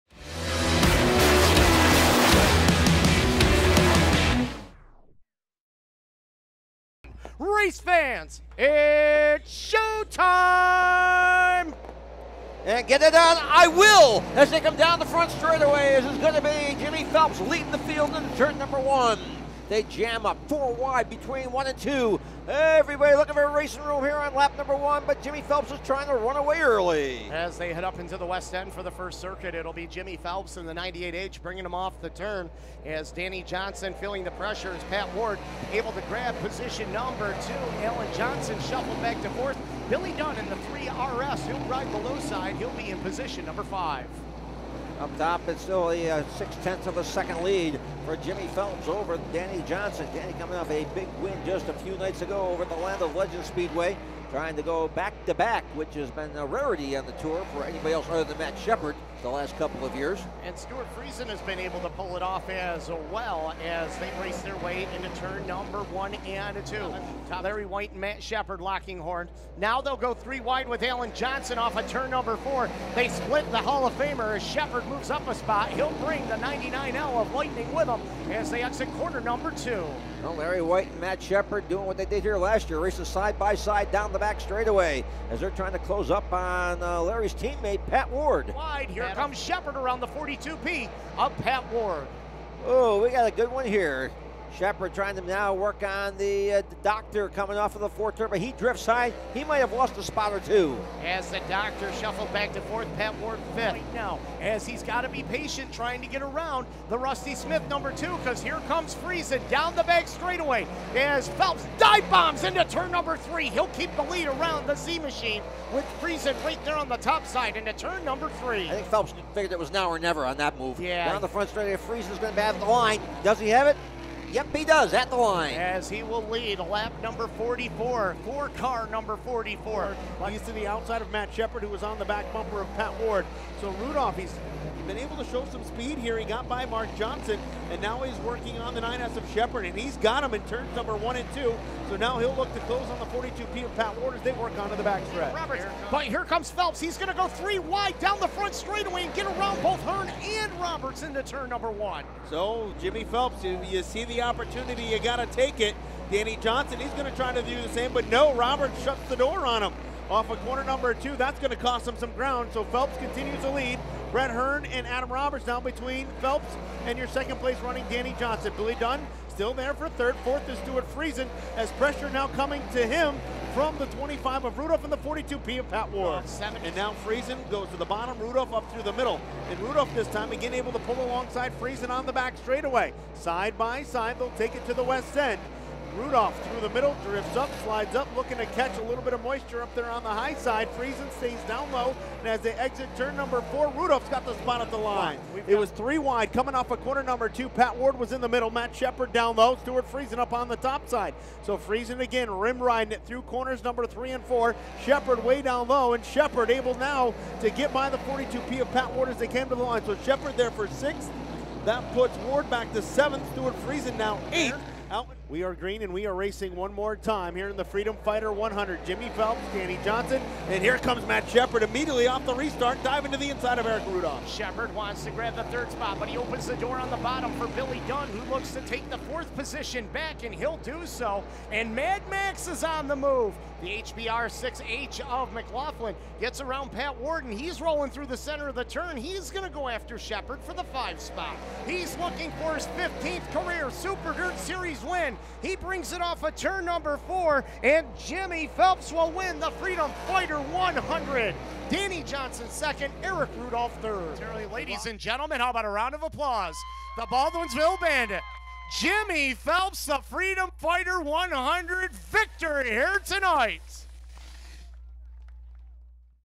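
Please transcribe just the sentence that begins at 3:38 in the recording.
Jimmy Phelps, Danny Johnson, and here comes Matt Shepard immediately off the restart, diving to the inside of Erick Rudolph.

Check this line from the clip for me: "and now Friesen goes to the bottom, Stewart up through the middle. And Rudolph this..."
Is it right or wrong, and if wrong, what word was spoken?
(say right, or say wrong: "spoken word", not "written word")
wrong: "Rudolph", not "Stewart".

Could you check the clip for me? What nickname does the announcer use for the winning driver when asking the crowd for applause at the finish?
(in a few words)
The Baldwinsville Bandit.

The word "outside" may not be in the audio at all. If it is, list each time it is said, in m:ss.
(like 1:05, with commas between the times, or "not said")
2:10.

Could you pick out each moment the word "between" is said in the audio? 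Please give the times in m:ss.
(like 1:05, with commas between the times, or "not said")
0:21, 2:45.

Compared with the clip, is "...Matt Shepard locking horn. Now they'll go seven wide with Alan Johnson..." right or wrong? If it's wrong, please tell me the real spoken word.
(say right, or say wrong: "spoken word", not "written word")
wrong: "three", not "seven".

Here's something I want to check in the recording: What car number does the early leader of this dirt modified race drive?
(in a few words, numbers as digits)
98H.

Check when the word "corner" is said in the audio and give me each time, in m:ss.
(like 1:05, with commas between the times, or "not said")
1:18, 2:40, 3:16, 3:23.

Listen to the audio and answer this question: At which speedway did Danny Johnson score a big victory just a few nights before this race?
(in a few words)
Land of Legends Speedway.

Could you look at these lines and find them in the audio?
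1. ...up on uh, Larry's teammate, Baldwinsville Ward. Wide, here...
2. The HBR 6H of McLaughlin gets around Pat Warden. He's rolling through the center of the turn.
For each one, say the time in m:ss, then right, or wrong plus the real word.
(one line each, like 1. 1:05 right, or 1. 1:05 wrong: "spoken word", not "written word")
1. 1:26 wrong: "Pat", not "Baldwinsville"
2. 3:53 right.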